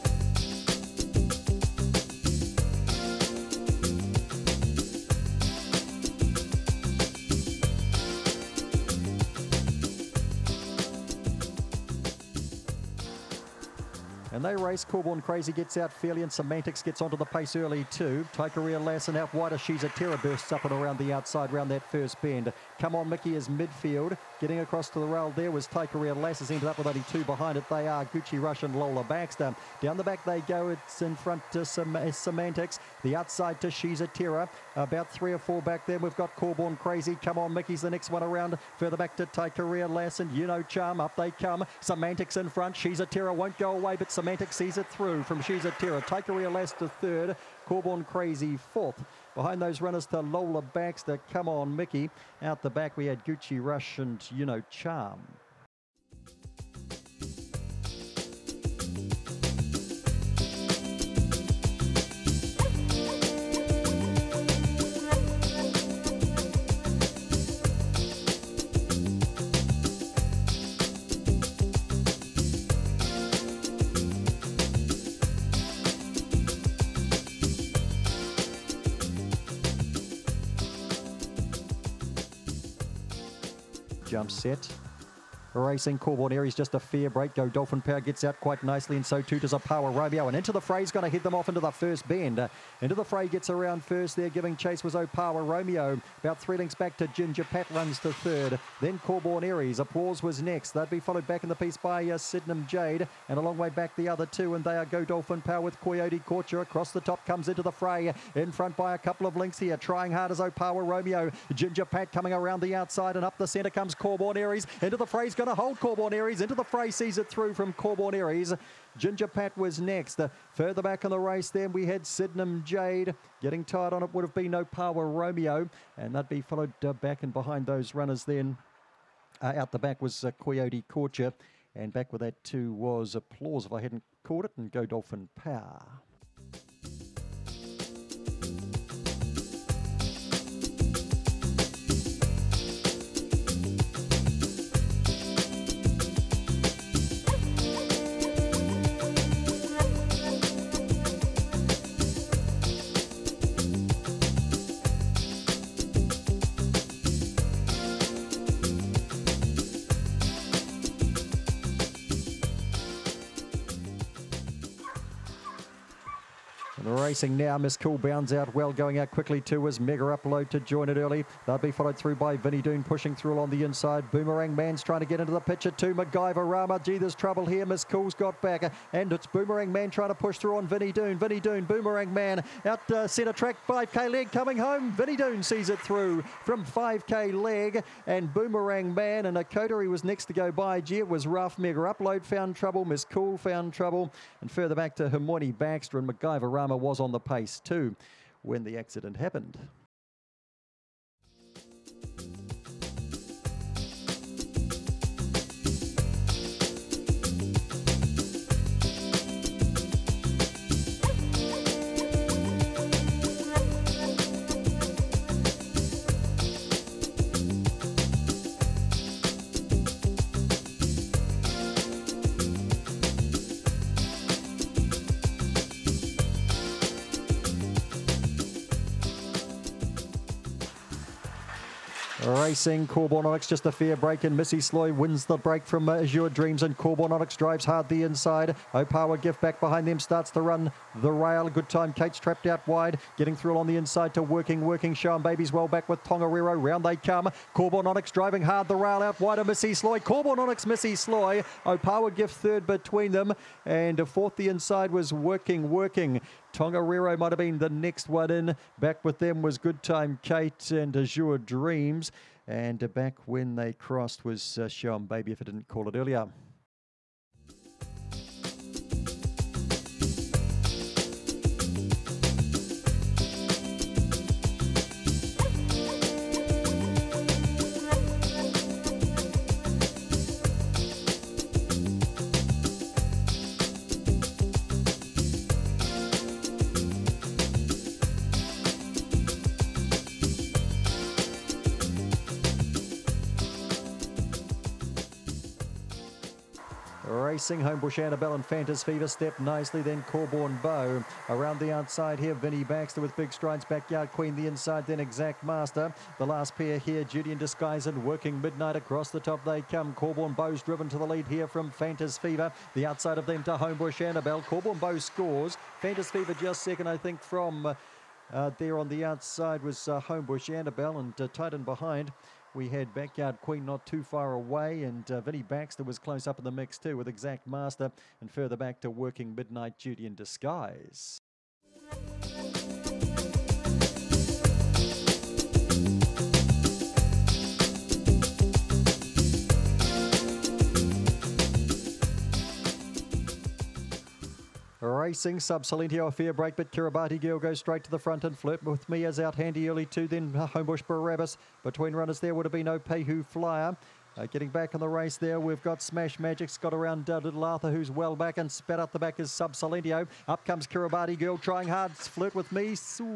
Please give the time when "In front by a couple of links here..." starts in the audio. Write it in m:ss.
1:48.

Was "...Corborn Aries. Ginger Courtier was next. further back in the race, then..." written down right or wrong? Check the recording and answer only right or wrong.
wrong.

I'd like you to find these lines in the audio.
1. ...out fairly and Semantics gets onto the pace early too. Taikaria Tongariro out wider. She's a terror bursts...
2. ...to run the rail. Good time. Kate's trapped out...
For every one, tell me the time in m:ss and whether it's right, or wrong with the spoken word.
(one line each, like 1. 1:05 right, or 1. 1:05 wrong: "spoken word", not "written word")
1. 0:15 wrong: "Lassen", not "Tongariro"
2. 4:00 right.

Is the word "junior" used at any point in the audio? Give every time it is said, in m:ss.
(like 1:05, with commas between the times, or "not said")
not said.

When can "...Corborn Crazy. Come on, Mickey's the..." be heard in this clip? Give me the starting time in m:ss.
0:36.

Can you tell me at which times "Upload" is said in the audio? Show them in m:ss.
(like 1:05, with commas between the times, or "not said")
2:50, 3:11.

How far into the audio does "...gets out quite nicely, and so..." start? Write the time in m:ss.
1:27.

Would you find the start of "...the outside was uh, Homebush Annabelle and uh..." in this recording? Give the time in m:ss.
5:18.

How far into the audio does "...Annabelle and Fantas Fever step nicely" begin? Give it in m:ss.
4:57.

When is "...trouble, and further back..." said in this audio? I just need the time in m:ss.
3:13.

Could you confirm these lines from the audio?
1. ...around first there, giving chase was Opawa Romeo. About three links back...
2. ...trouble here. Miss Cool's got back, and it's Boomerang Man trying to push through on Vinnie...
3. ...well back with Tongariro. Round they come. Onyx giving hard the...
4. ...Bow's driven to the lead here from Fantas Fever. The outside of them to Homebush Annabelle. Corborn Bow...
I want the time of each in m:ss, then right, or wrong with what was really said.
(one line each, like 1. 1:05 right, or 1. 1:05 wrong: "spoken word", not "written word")
1. 1:33 right
2. 2:57 right
3. 4:05 wrong: "driving", not "giving"
4. 5:10 right.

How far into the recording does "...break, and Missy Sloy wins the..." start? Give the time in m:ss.
3:53.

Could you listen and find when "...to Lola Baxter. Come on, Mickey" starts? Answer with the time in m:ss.
0:50.